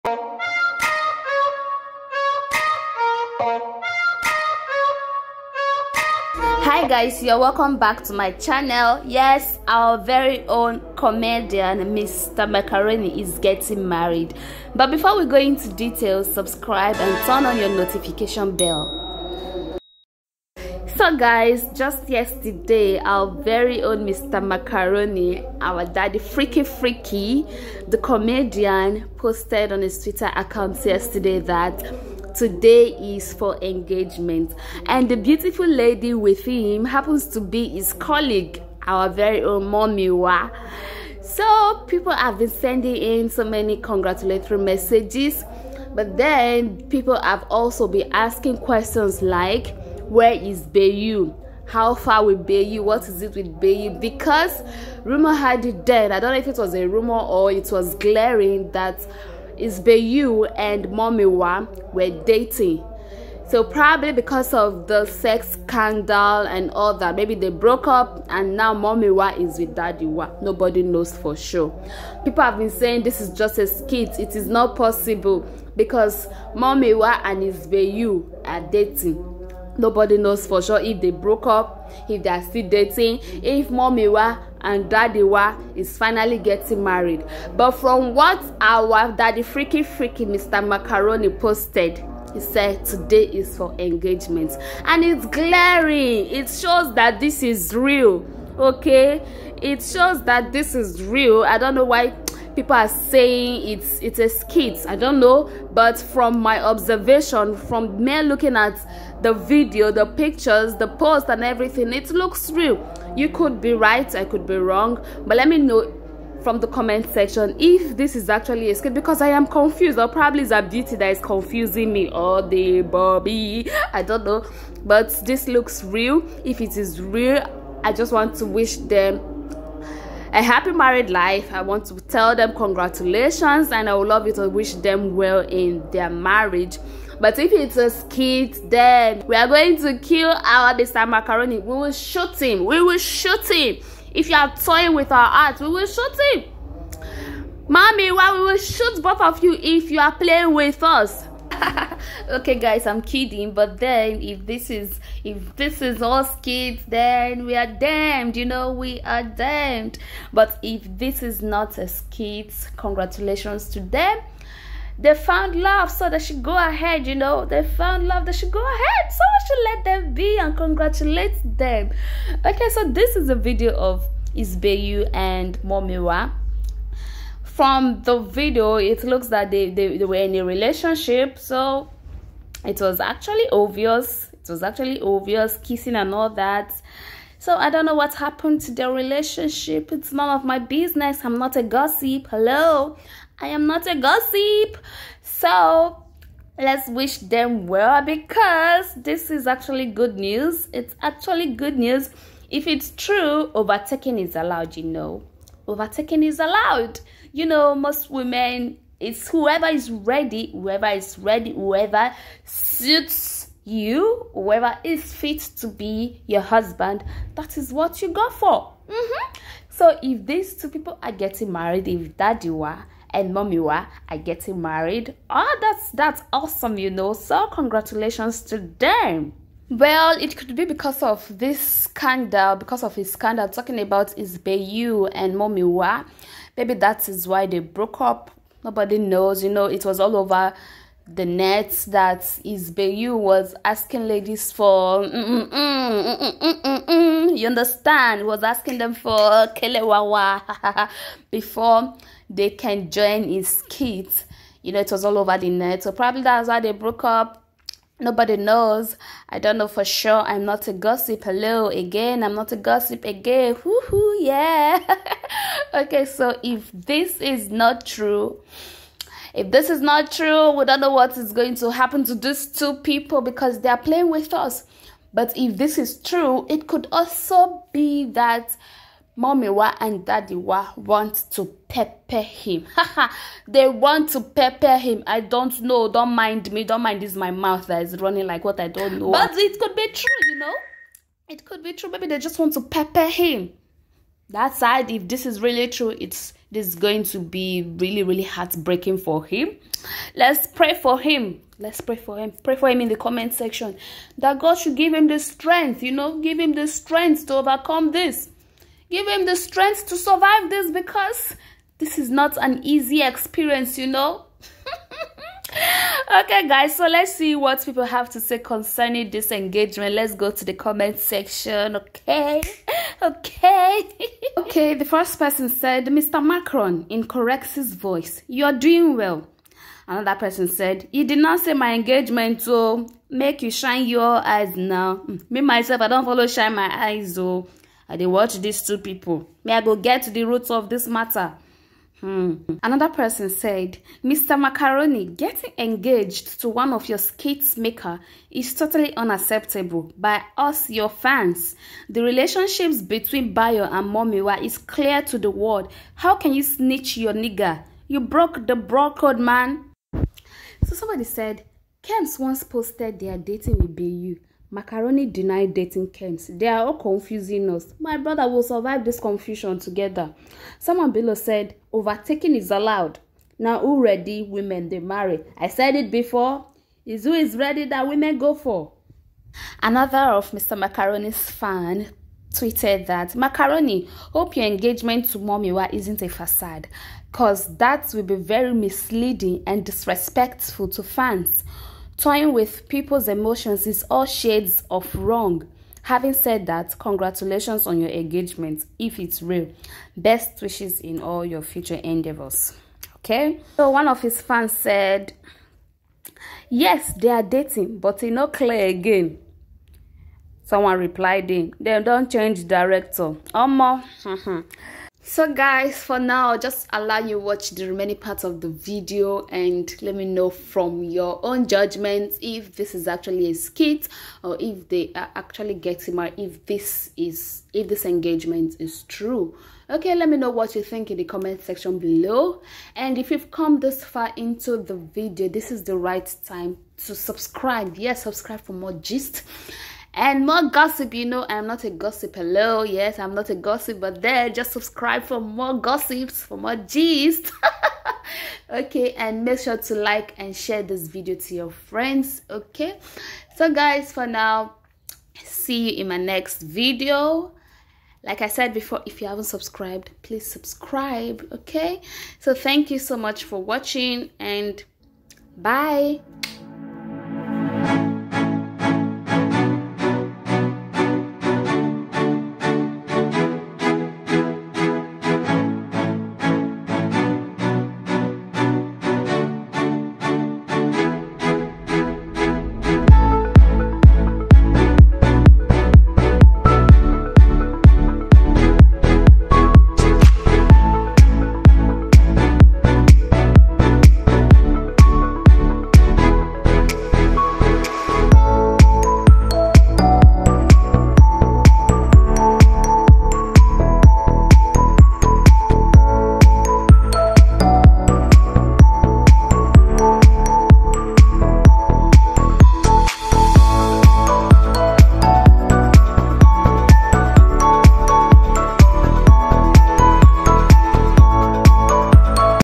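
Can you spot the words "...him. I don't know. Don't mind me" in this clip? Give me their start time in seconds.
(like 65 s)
284 s.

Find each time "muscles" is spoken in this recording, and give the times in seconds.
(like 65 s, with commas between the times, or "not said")
not said.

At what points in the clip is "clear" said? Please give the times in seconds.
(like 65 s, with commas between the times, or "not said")
354 s, 408 s.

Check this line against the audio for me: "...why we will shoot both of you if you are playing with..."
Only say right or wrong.
right.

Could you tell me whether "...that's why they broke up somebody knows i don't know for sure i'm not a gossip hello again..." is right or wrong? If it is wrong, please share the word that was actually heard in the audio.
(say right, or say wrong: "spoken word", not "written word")
wrong: "nobody", not "somebody".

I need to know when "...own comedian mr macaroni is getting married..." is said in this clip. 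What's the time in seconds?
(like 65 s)
10 s.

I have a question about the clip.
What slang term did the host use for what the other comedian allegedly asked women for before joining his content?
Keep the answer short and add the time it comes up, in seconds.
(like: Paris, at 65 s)
kelewawa, at 249 s.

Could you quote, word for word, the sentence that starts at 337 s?
i did watch these two people may i go get to the roots of this matter Hmm.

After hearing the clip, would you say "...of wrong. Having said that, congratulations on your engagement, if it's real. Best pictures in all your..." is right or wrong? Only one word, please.
wrong.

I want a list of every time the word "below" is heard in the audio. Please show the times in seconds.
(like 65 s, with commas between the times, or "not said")
370 s, 431 s.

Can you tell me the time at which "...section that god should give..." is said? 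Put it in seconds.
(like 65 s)
303 s.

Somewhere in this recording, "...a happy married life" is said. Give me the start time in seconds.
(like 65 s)
130 s.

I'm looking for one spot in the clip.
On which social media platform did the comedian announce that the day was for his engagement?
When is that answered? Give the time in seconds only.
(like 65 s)
30 s.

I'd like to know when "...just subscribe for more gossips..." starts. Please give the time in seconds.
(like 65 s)
444 s.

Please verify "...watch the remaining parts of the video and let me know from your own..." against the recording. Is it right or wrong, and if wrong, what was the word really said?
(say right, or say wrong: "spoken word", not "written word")
right.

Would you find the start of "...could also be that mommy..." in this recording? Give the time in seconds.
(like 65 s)
276 s.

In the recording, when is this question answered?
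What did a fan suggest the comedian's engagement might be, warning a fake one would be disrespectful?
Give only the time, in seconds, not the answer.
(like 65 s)
386 s.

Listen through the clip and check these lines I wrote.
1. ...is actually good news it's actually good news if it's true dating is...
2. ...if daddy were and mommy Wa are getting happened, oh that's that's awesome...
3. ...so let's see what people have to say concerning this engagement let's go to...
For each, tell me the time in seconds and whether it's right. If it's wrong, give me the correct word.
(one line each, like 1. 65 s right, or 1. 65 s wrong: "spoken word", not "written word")
1. 199 s wrong: "overtaking", not "dating"
2. 221 s wrong: "married", not "happened"
3. 316 s right.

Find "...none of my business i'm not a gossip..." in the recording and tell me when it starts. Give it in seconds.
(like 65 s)
190 s.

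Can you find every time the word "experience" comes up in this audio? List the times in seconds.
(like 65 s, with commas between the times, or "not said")
313 s.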